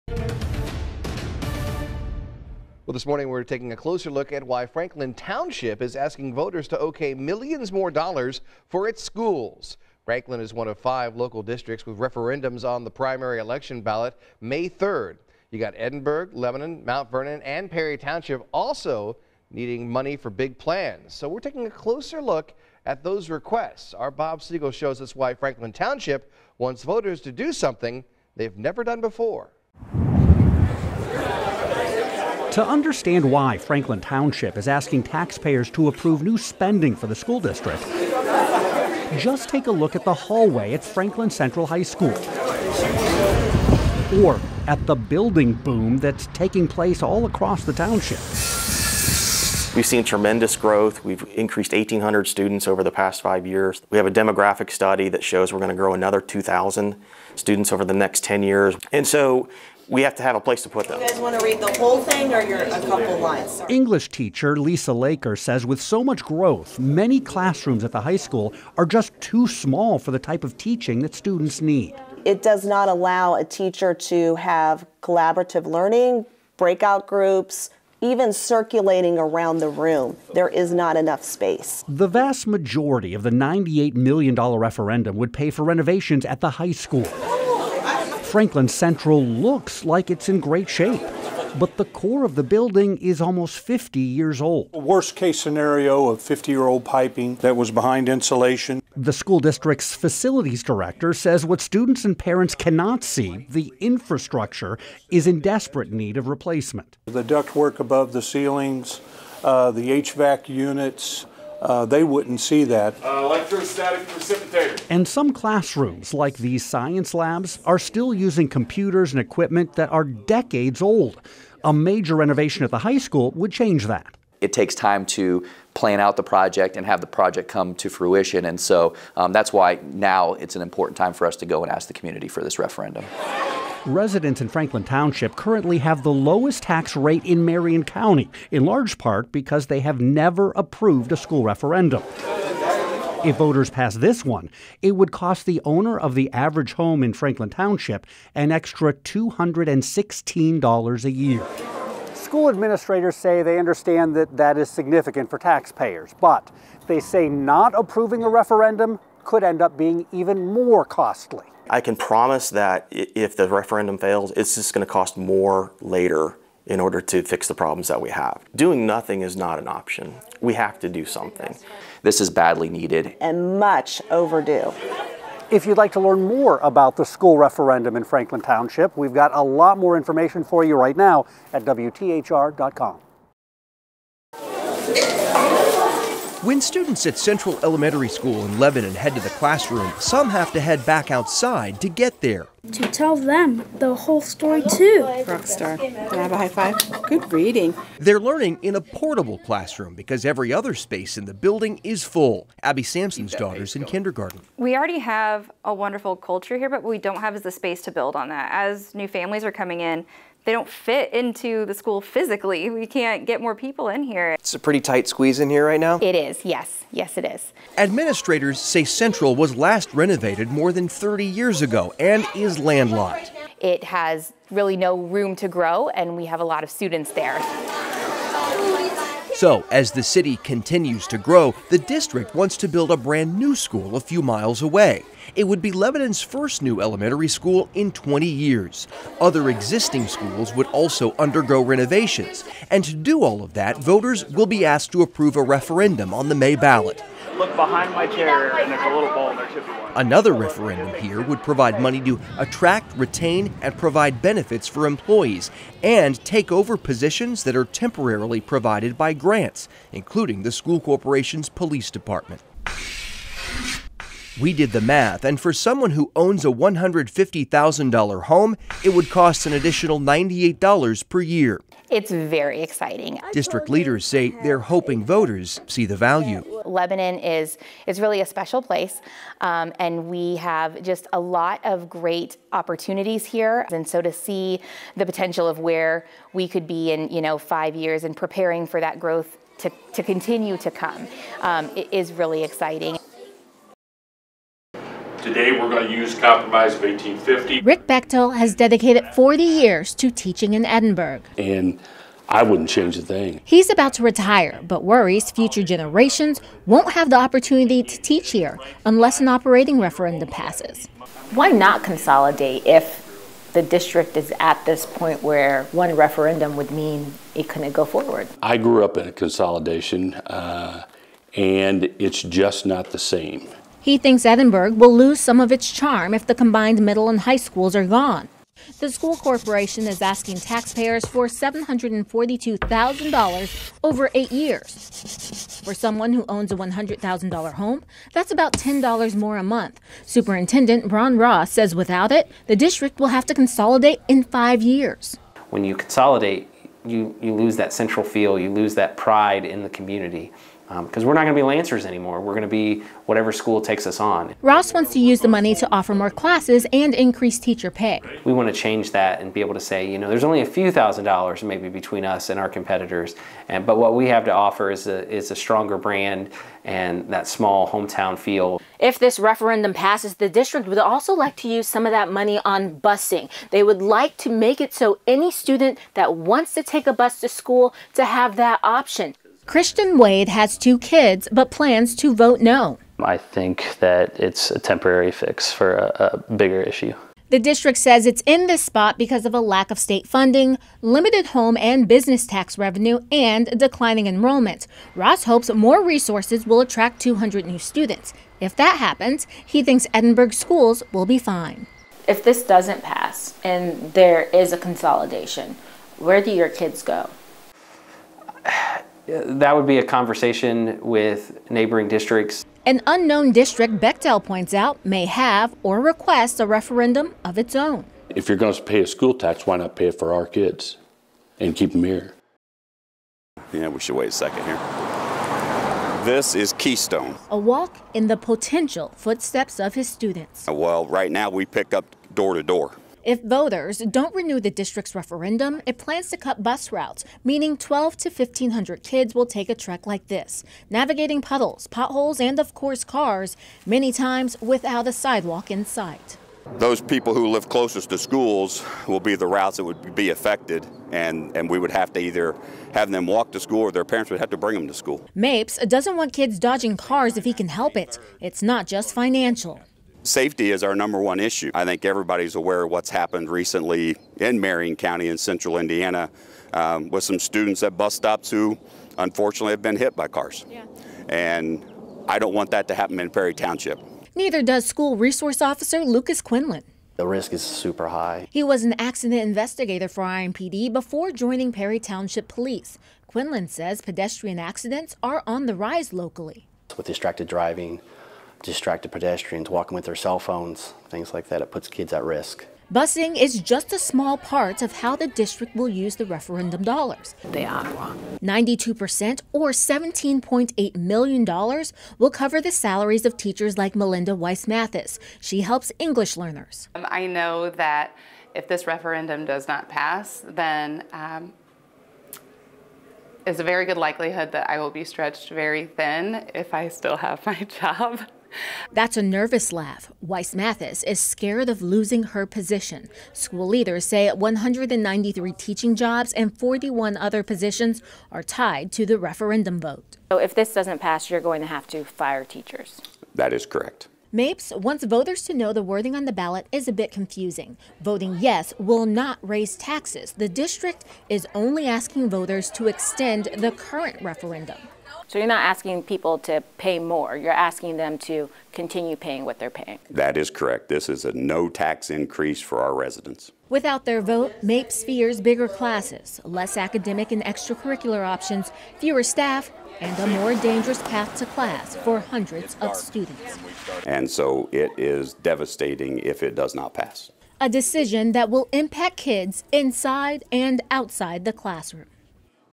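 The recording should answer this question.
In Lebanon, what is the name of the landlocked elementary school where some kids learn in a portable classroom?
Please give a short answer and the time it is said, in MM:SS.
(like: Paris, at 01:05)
Central Elementary School, at 03:07.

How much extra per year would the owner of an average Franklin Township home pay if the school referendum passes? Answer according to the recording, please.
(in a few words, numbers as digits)
$216.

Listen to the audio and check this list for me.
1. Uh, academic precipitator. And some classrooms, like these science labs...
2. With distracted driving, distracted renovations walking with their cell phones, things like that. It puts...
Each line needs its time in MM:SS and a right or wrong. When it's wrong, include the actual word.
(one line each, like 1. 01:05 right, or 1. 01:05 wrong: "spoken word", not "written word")
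1. 01:53 wrong: "electrostatic", not "academic"
2. 08:06 wrong: "pedestrians", not "renovations".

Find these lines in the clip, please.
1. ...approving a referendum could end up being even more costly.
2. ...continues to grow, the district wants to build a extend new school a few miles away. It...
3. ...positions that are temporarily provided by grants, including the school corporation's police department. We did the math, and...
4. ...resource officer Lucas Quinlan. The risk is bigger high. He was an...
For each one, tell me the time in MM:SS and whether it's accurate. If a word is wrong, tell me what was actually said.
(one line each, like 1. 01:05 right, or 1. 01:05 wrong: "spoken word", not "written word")
1. 02:37 right
2. 03:50 wrong: "brand", not "extend"
3. 04:16 right
4. 07:54 wrong: "super", not "bigger".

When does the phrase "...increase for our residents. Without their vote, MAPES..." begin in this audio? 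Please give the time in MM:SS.
09:11.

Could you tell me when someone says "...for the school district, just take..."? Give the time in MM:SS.
00:36.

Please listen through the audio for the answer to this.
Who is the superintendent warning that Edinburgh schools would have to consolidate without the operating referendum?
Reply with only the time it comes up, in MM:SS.
05:40.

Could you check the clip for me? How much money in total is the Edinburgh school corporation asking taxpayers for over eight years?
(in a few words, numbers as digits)
$742,000.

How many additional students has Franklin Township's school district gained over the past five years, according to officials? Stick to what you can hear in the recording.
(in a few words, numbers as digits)
1,800.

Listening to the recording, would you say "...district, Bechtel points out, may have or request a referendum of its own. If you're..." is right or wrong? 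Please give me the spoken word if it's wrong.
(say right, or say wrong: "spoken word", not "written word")
right.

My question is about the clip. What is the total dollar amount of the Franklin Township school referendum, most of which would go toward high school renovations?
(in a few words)
$98 million.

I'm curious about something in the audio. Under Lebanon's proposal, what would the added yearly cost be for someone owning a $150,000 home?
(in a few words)
$98.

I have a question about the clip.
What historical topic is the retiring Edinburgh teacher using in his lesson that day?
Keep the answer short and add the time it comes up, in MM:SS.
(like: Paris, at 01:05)
Compromise of 1850, at 04:56.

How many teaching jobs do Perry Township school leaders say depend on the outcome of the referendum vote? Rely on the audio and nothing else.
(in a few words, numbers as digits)
193.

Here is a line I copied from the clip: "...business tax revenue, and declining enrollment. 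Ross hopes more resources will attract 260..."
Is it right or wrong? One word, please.
wrong.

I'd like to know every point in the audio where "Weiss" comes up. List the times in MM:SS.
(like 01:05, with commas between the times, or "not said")
08:24, 08:40.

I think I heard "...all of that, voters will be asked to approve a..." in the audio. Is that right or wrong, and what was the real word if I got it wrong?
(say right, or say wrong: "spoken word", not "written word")
right.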